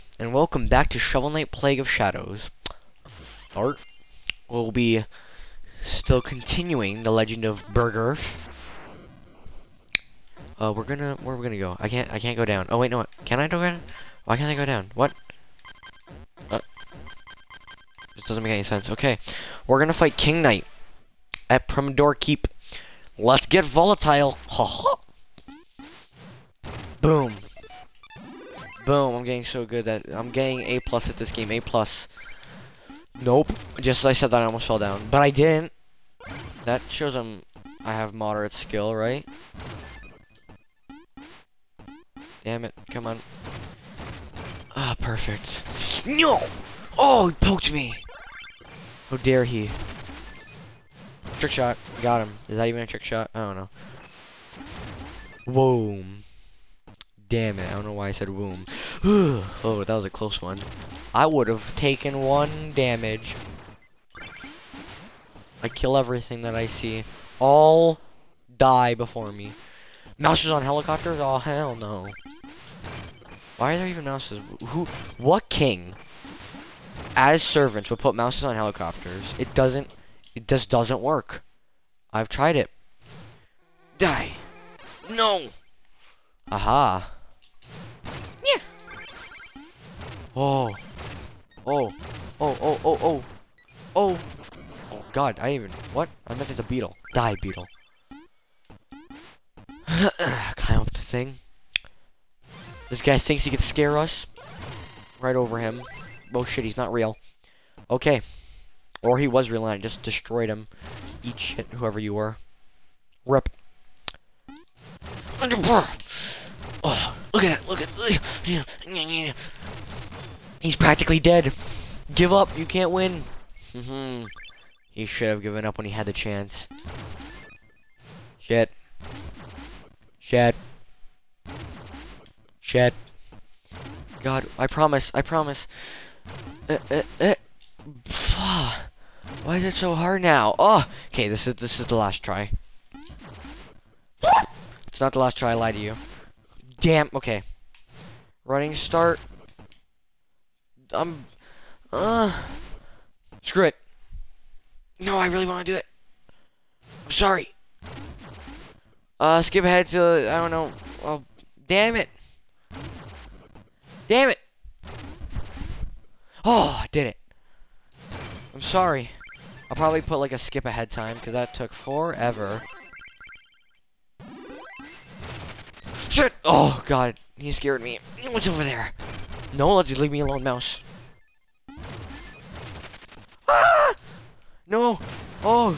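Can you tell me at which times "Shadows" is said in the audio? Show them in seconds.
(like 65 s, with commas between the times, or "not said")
1 s.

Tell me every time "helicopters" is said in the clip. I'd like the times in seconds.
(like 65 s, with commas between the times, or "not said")
70 s, 78 s.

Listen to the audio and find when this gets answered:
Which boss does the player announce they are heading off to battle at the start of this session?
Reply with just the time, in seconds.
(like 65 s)
20 s.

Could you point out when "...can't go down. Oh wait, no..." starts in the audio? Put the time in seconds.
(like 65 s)
12 s.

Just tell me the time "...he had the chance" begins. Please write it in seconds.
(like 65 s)
125 s.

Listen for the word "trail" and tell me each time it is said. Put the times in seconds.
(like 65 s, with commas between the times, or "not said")
not said.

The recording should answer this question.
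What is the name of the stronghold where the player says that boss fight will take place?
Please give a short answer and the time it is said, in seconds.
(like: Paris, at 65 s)
Pridemoor Keep, at 21 s.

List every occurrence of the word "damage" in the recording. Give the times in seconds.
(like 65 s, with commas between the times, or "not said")
62 s.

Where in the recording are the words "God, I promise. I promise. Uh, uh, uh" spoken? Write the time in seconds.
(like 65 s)
134 s.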